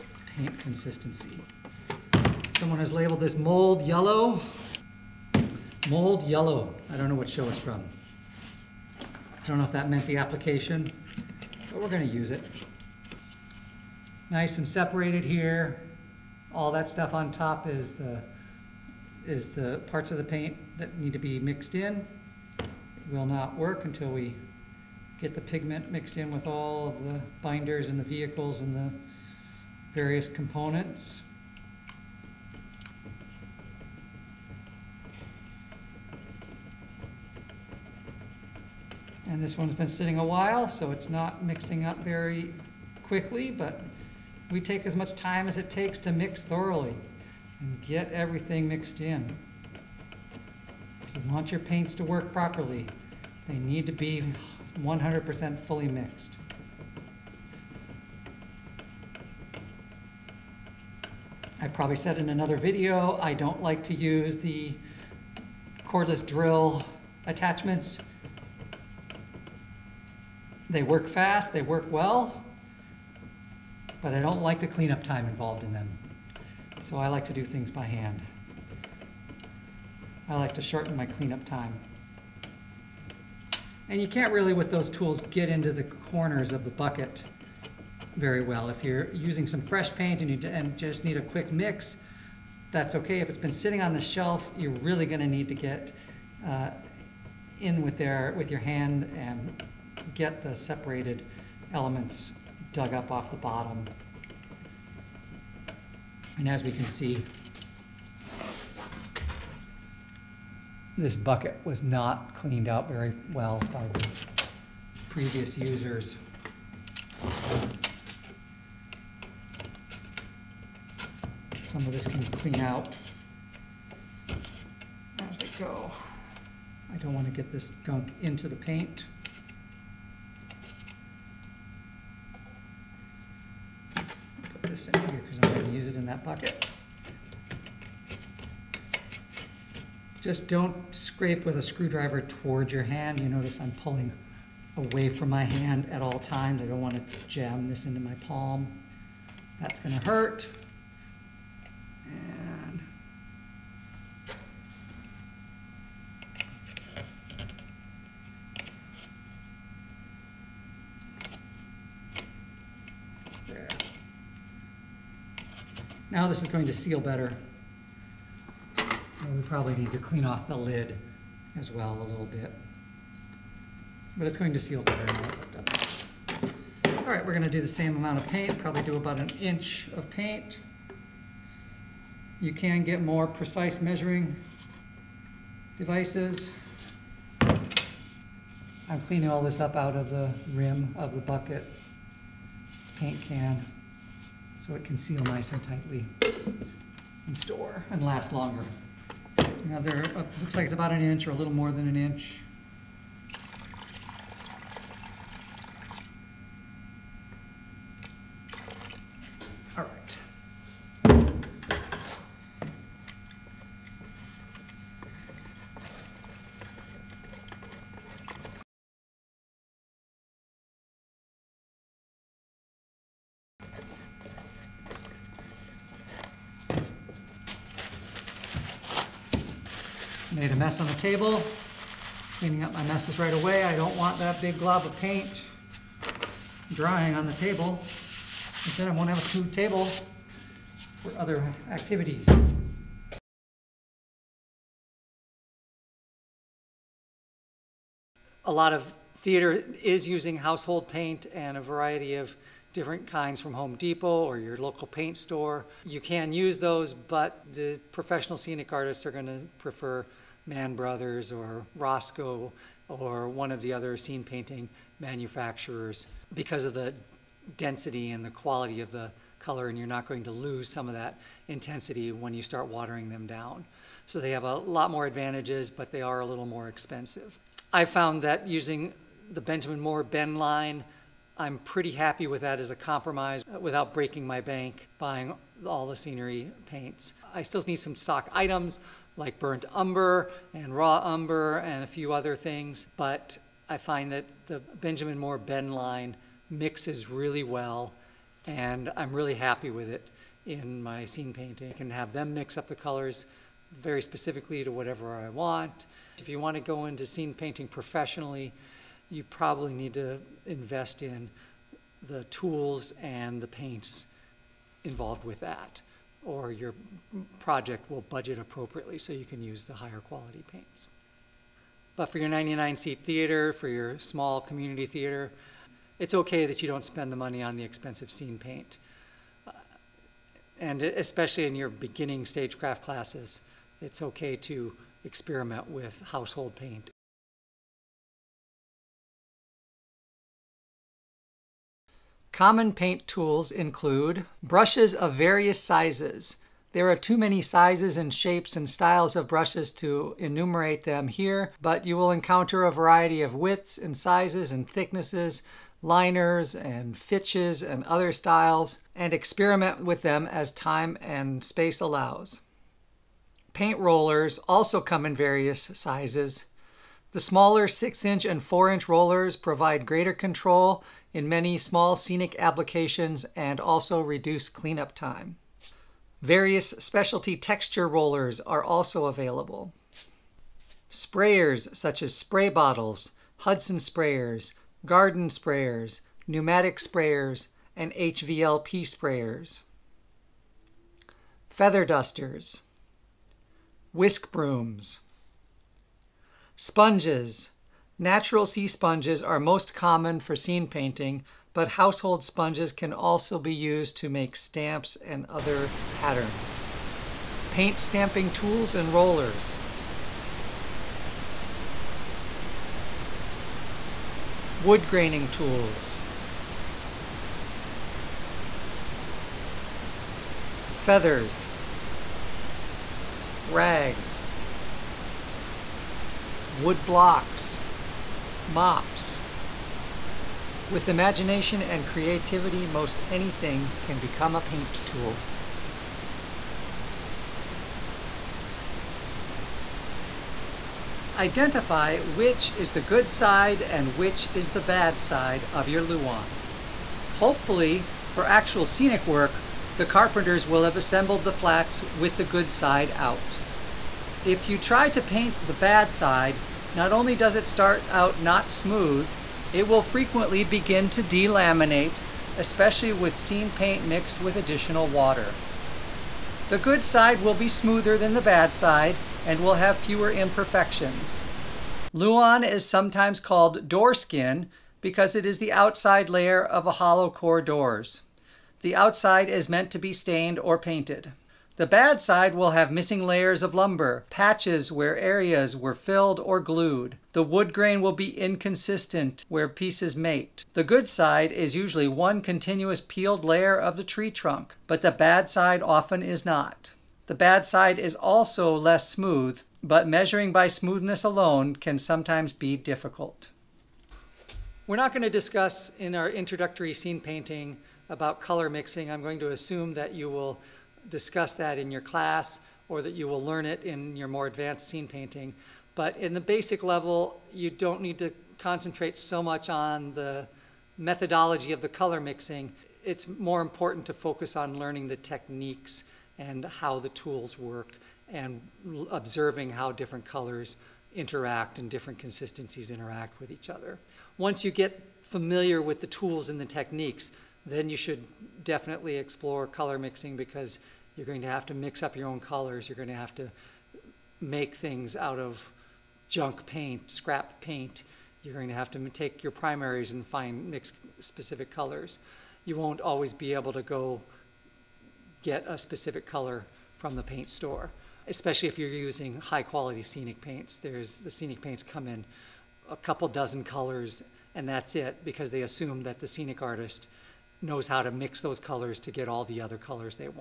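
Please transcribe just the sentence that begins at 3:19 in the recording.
Now, there uh, looks like it's about an inch or a little more than an inch.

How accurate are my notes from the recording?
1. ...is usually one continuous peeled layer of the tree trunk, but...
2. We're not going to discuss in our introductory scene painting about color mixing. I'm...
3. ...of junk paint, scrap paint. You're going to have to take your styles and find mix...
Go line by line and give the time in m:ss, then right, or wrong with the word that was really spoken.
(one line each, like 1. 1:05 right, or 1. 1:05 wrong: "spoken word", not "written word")
1. 8:11 right
2. 8:24 right
3. 9:05 wrong: "primaries", not "styles".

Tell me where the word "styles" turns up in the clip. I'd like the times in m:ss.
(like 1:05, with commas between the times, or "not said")
5:48, 5:58.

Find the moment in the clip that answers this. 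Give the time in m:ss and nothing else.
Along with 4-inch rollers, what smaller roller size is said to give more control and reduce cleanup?
6:07.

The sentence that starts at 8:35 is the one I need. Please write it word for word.
But in the basic level, you don't need to concentrate so much on the methodology of the color mixing.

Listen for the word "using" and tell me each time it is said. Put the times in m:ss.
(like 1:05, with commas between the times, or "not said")
1:29, 4:10, 4:38, 9:18.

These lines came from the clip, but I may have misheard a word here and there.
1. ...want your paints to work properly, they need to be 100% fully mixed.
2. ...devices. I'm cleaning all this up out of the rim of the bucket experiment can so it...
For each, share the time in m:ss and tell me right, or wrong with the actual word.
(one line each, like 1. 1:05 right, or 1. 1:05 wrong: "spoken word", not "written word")
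1. 0:51 right
2. 3:05 wrong: "paint", not "experiment".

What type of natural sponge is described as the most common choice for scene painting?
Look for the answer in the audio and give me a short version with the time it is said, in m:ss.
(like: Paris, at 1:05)
Sea sponges, at 6:37.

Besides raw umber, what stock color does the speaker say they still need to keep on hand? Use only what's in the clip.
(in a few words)
Burnt umber.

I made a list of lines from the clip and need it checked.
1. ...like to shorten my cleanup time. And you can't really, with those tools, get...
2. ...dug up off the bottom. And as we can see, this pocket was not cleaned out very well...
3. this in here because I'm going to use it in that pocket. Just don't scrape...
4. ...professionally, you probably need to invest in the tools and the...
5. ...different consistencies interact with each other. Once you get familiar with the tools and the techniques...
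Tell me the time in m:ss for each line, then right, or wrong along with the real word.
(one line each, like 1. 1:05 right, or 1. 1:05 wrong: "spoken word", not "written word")
1. 1:20 right
2. 1:42 wrong: "bucket", not "pocket"
3. 2:14 right
4. 5:07 right
5. 8:51 right.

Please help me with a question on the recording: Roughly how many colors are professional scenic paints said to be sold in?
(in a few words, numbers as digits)
A couple dozen.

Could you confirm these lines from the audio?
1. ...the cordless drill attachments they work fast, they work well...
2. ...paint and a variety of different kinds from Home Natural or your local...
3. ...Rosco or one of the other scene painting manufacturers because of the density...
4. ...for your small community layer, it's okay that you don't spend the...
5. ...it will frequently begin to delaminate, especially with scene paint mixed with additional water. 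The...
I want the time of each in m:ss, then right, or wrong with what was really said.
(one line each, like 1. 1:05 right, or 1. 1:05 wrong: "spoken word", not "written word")
1. 1:04 right
2. 4:10 wrong: "Depot", not "Natural"
3. 4:21 right
4. 5:23 wrong: "theater", not "layer"
5. 7:39 right.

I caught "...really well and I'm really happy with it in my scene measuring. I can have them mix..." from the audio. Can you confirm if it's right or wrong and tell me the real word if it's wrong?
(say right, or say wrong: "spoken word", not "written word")
wrong: "painting", not "measuring".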